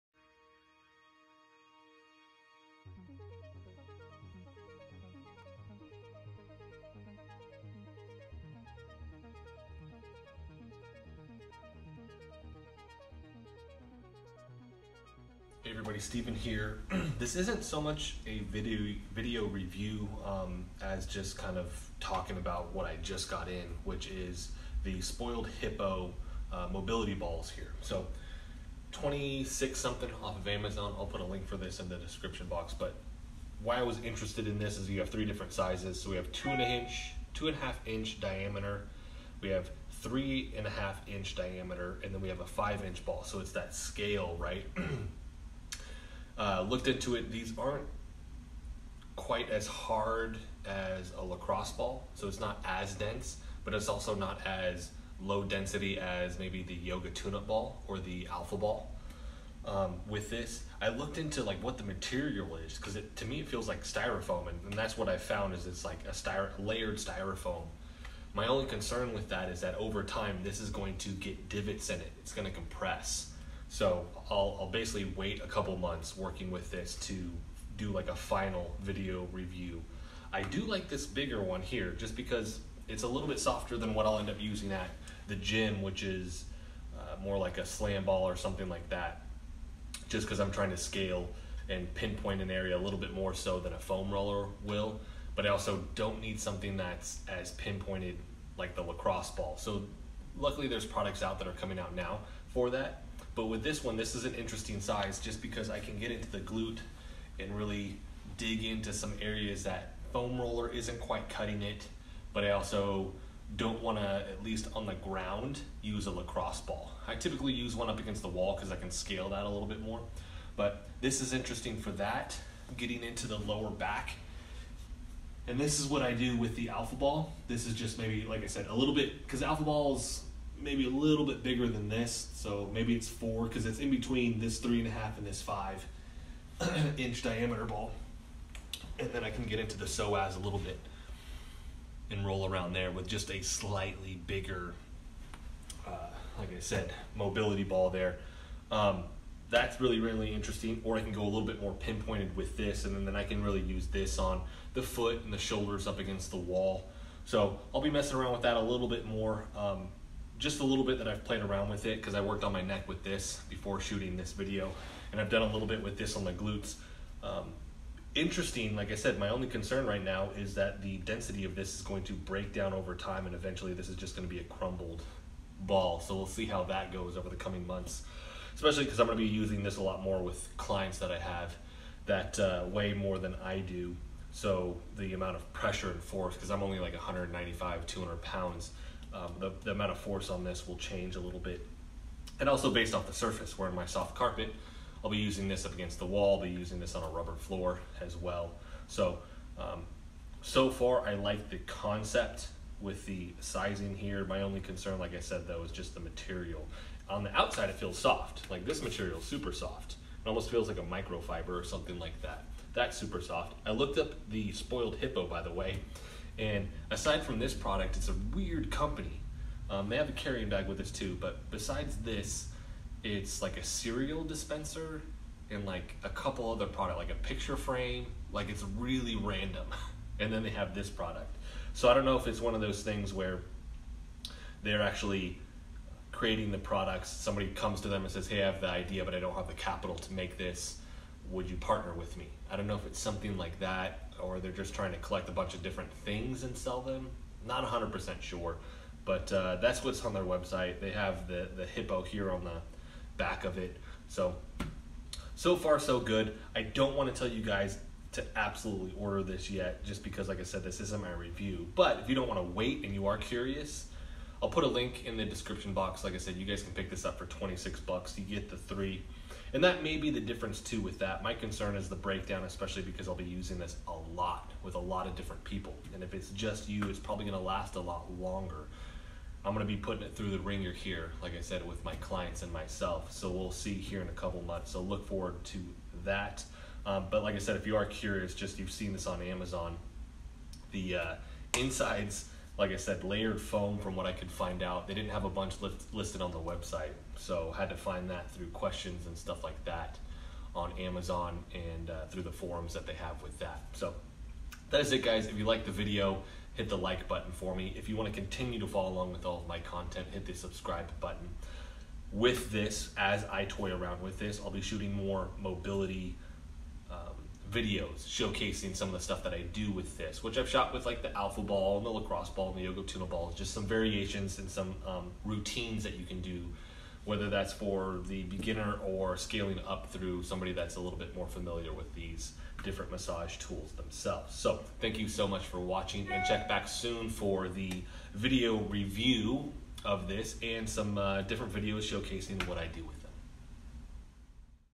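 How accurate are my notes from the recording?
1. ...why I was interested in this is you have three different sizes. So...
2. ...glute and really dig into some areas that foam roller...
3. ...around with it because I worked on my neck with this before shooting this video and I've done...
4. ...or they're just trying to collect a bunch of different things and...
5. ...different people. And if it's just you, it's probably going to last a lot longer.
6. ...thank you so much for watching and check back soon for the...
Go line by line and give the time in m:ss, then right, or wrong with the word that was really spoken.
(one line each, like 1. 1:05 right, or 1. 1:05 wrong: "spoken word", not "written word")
1. 0:33 right
2. 1:46 right
3. 2:41 right
4. 4:04 right
5. 4:35 right
6. 5:34 right.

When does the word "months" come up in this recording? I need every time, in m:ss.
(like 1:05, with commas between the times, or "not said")
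1:15, 2:57, 4:44.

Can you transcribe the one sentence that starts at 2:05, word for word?
And this is what I do with the alpha ball.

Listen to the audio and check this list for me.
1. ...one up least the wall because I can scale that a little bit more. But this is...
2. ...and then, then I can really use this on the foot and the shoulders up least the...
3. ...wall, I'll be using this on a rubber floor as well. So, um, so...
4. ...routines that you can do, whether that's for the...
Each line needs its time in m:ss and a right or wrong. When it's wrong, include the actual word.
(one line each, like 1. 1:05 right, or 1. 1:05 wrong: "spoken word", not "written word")
1. 1:57 wrong: "against", not "least"
2. 2:32 wrong: "against", not "least"
3. 3:16 right
4. 5:25 right.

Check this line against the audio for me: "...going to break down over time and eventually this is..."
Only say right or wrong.
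right.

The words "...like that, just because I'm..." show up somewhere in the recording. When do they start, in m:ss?
1:28.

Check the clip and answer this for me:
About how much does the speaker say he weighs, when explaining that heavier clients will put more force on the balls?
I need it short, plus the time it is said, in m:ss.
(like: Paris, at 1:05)
195 to 200 pounds, at 3:06.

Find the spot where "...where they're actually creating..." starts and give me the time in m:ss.
3:53.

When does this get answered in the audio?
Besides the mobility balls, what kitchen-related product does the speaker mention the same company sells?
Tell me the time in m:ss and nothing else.
3:43.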